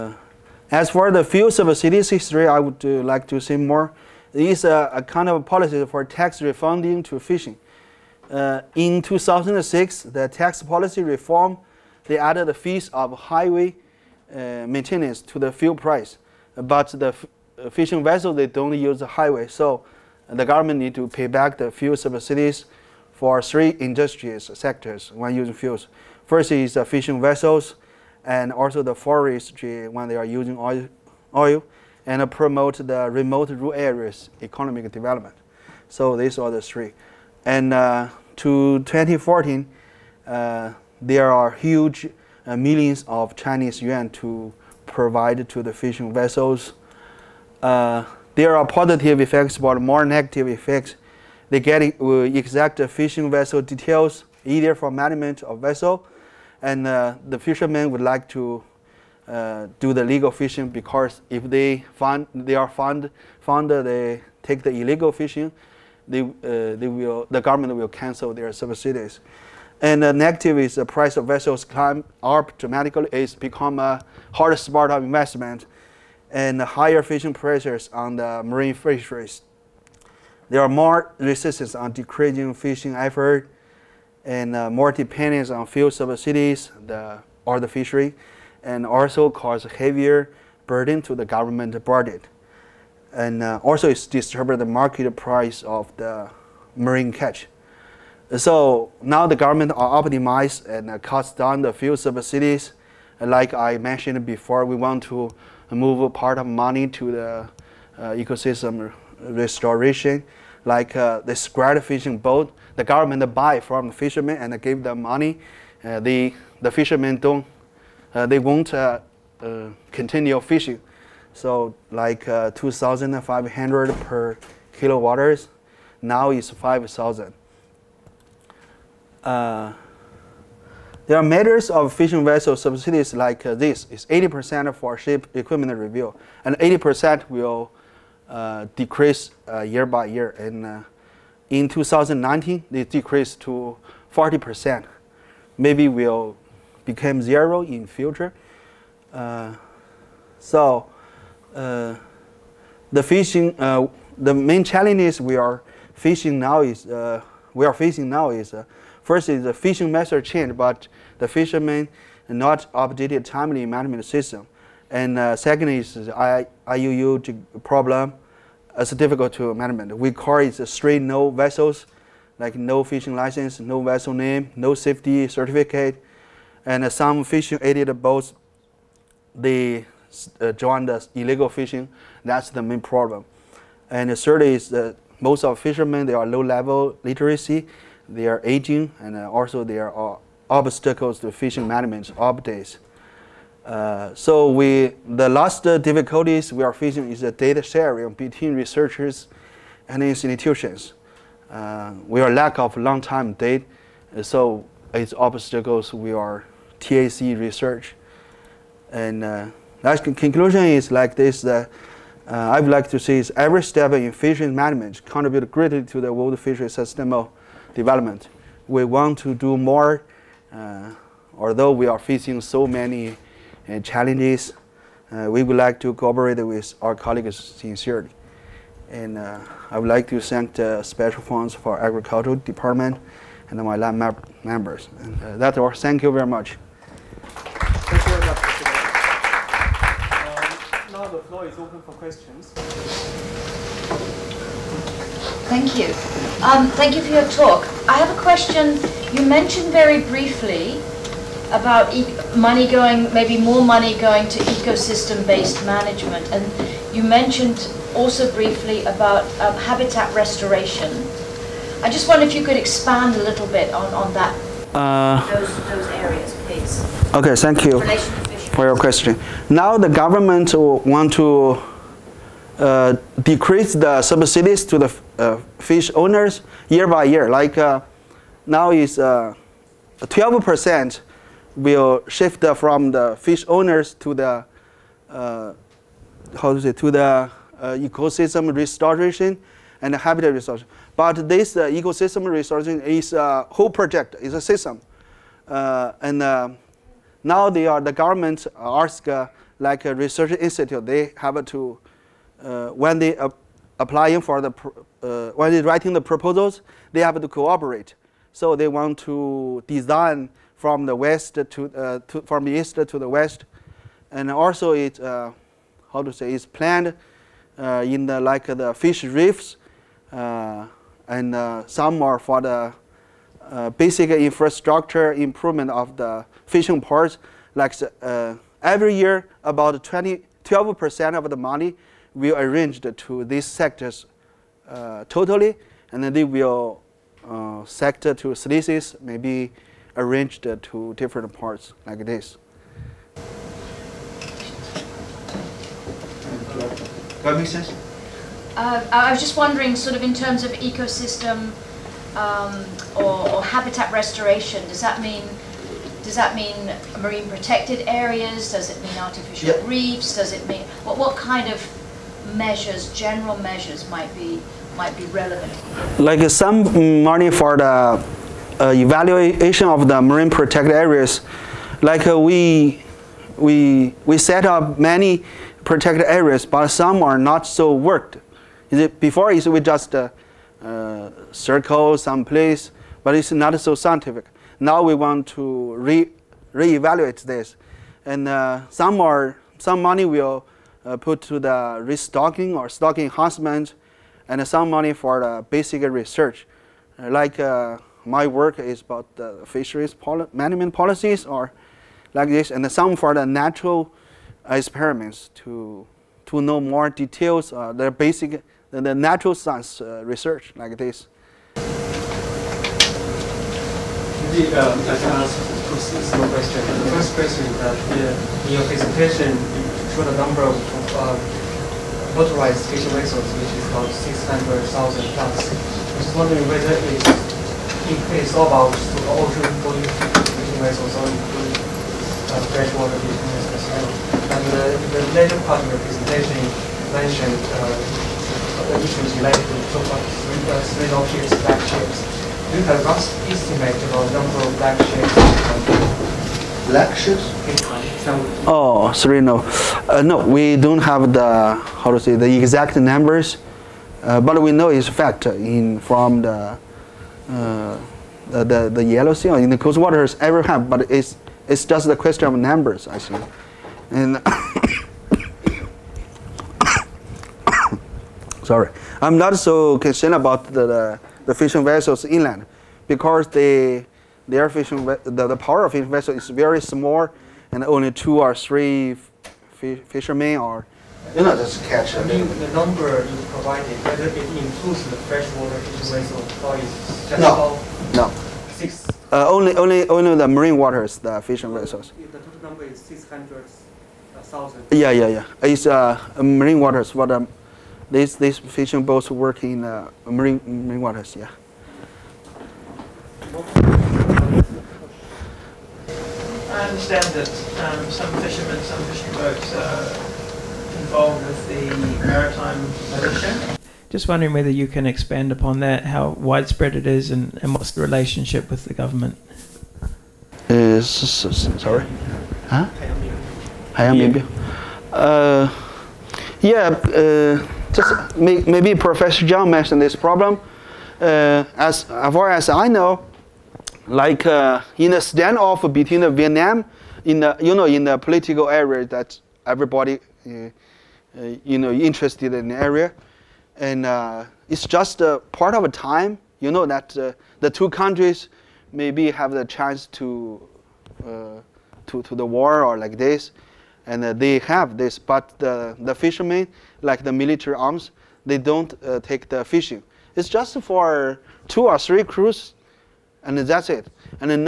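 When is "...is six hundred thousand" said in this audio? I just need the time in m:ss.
8:12.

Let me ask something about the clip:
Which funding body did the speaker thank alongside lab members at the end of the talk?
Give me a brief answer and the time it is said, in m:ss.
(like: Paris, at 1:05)
Special Funds for Agricultural Department, at 3:50.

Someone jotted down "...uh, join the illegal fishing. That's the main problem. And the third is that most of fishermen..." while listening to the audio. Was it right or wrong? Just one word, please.
right.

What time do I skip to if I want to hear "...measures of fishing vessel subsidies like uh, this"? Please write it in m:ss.
2:11.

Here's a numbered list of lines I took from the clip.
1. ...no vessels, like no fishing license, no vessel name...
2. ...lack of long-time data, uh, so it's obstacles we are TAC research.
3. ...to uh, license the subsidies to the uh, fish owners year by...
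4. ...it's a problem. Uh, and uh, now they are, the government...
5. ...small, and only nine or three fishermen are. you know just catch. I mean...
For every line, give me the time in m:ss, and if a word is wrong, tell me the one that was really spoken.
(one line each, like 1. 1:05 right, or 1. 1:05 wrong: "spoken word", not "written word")
1. 2:51 right
2. 3:22 right
3. 4:31 wrong: "decrease", not "license"
4. 4:54 wrong: "system", not "problem"
5. 7:56 wrong: "two", not "nine".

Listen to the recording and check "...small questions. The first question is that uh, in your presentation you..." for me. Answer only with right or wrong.
right.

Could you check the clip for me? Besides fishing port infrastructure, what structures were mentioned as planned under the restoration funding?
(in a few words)
fish reefs.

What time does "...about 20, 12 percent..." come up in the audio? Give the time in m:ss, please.
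5:29.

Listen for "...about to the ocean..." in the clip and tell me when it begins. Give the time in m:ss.
7:08.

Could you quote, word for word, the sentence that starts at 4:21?
I just wonder if you could expand a little bit on, on that, uh, those, those areas, please.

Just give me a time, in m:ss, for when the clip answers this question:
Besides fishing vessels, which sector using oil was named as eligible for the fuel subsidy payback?
0:28.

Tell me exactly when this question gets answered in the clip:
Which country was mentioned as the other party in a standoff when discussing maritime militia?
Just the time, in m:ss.
8:56.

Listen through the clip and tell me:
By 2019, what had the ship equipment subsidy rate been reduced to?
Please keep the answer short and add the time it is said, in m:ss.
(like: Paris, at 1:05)
40%, at 2:24.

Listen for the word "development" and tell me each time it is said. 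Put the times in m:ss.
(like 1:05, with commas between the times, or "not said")
0:34, 3:37.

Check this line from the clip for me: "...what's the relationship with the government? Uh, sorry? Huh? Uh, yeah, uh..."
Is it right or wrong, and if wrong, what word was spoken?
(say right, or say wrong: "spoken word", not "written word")
right.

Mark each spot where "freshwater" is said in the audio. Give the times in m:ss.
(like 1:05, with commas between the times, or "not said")
7:12, 8:05.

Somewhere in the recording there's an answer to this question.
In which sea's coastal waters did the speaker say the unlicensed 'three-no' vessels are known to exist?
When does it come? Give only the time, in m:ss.
7:38.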